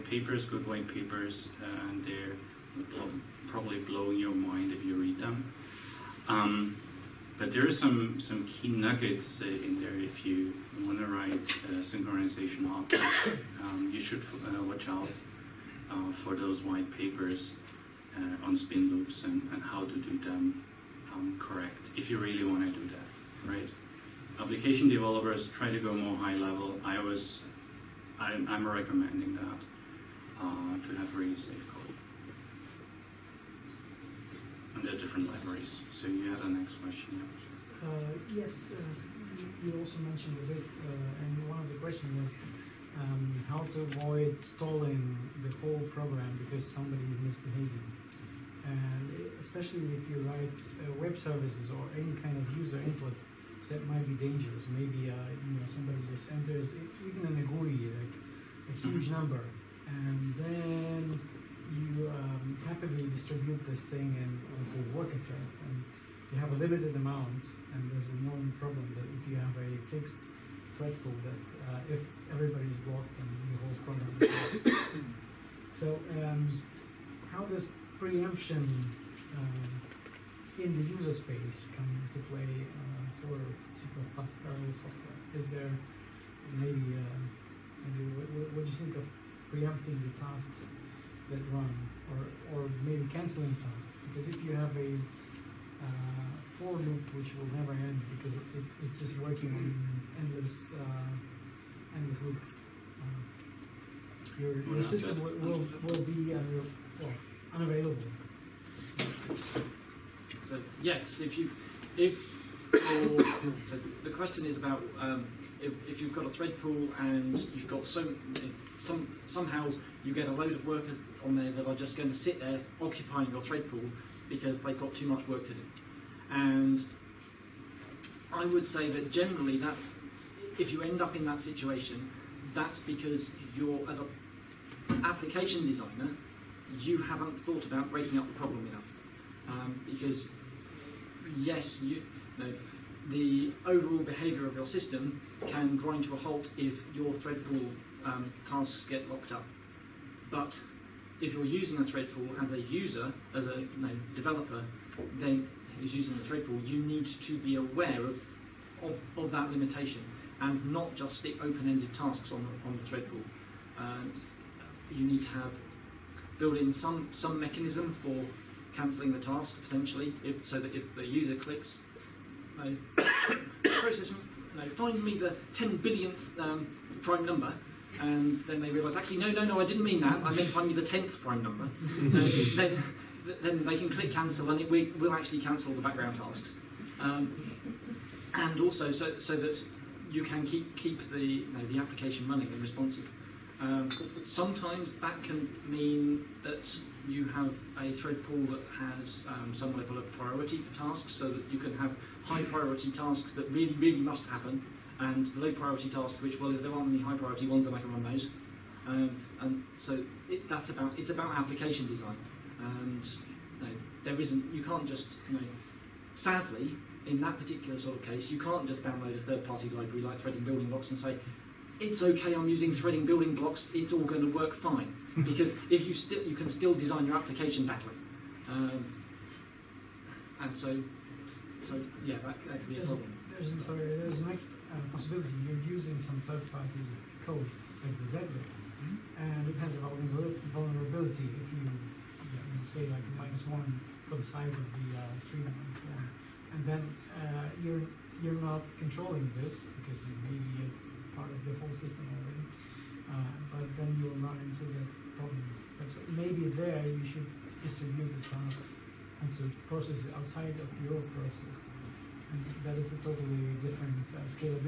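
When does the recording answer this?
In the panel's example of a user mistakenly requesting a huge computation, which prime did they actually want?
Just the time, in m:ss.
3:00.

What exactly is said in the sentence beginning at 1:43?
Uh, your, your system will, will, will be uh, well, unavailable.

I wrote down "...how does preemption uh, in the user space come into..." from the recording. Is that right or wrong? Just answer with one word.
right.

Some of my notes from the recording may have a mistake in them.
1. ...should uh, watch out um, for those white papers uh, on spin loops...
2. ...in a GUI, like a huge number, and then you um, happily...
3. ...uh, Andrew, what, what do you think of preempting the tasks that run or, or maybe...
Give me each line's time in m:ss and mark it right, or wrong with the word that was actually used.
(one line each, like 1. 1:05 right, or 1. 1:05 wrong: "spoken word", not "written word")
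1. 0:14 right
2. 0:57 right
3. 1:26 right.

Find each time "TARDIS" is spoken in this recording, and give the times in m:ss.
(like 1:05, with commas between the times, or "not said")
not said.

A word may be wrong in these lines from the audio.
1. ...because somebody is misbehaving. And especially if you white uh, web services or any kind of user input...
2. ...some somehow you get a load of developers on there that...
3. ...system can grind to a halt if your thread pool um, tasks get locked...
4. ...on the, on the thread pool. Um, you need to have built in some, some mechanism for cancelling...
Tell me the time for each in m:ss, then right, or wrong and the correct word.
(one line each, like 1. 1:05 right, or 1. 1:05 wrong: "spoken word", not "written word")
1. 0:46 wrong: "write", not "white"
2. 1:58 wrong: "workers", not "developers"
3. 2:24 right
4. 2:42 right.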